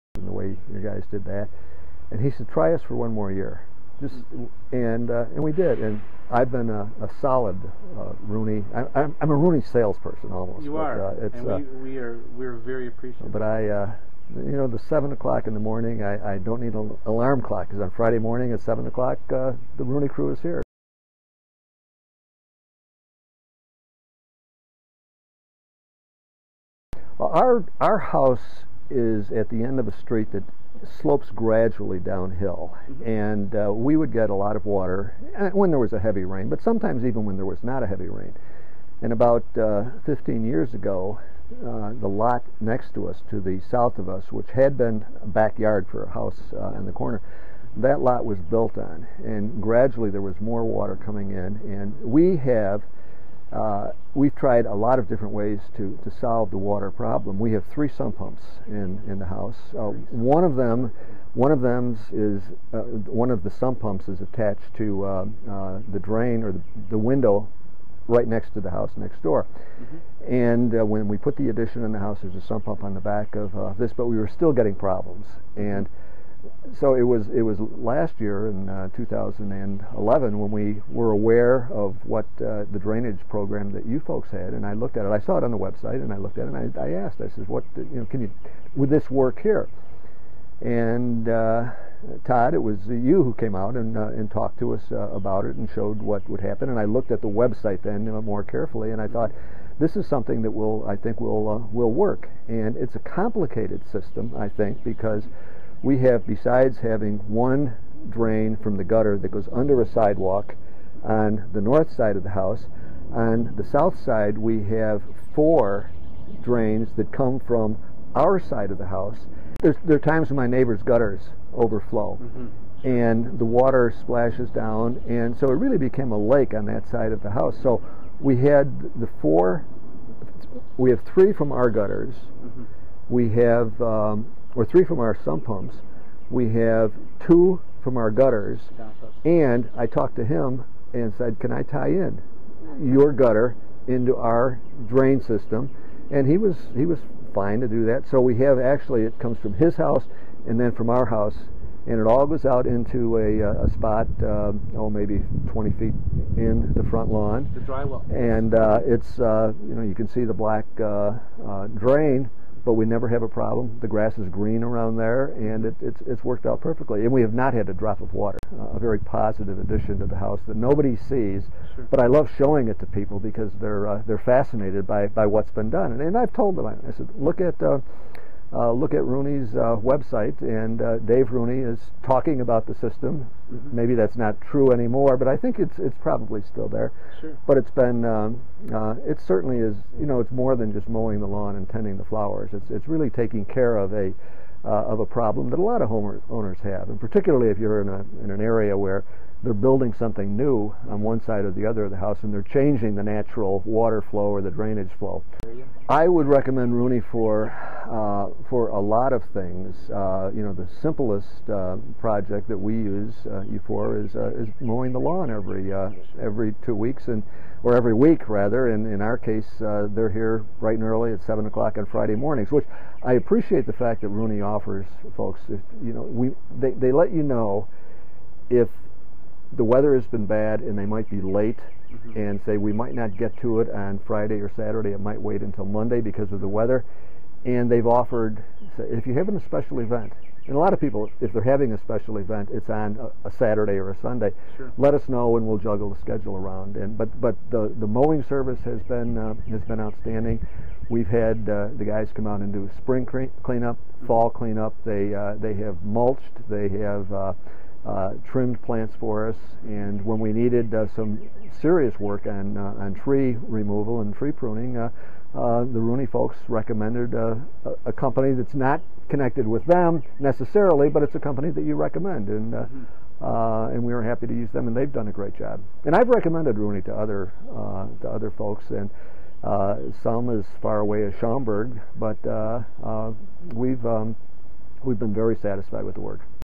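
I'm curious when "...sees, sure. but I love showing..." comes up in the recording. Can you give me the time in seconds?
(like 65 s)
170 s.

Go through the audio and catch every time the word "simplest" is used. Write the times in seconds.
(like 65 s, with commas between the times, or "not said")
210 s.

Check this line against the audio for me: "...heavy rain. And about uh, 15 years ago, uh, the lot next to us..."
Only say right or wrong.
right.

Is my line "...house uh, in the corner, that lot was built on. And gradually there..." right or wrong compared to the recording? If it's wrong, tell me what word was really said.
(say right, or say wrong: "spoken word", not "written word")
right.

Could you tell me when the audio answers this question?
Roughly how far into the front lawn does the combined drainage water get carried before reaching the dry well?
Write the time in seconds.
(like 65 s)
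155 s.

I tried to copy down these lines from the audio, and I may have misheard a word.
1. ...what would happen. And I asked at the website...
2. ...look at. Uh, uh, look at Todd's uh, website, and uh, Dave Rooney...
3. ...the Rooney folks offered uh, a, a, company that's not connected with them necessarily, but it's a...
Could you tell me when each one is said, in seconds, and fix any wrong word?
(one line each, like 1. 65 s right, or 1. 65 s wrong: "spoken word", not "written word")
1. 96 s wrong: "looked", not "asked"
2. 177 s wrong: "Rooney", not "Todd"
3. 265 s wrong: "recommended", not "offered".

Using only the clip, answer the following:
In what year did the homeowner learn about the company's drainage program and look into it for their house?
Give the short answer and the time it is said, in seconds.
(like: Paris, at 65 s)
2011, at 78 s.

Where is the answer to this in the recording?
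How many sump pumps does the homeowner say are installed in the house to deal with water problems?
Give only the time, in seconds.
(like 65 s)
57 s.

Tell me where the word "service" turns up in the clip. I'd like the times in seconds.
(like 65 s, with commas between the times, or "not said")
248 s.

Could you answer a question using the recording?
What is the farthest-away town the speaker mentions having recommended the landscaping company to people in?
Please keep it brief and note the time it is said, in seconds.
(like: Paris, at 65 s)
Schaumburg, at 281 s.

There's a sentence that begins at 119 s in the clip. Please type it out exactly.
There's, there are times when my neighbor's gutters overflow.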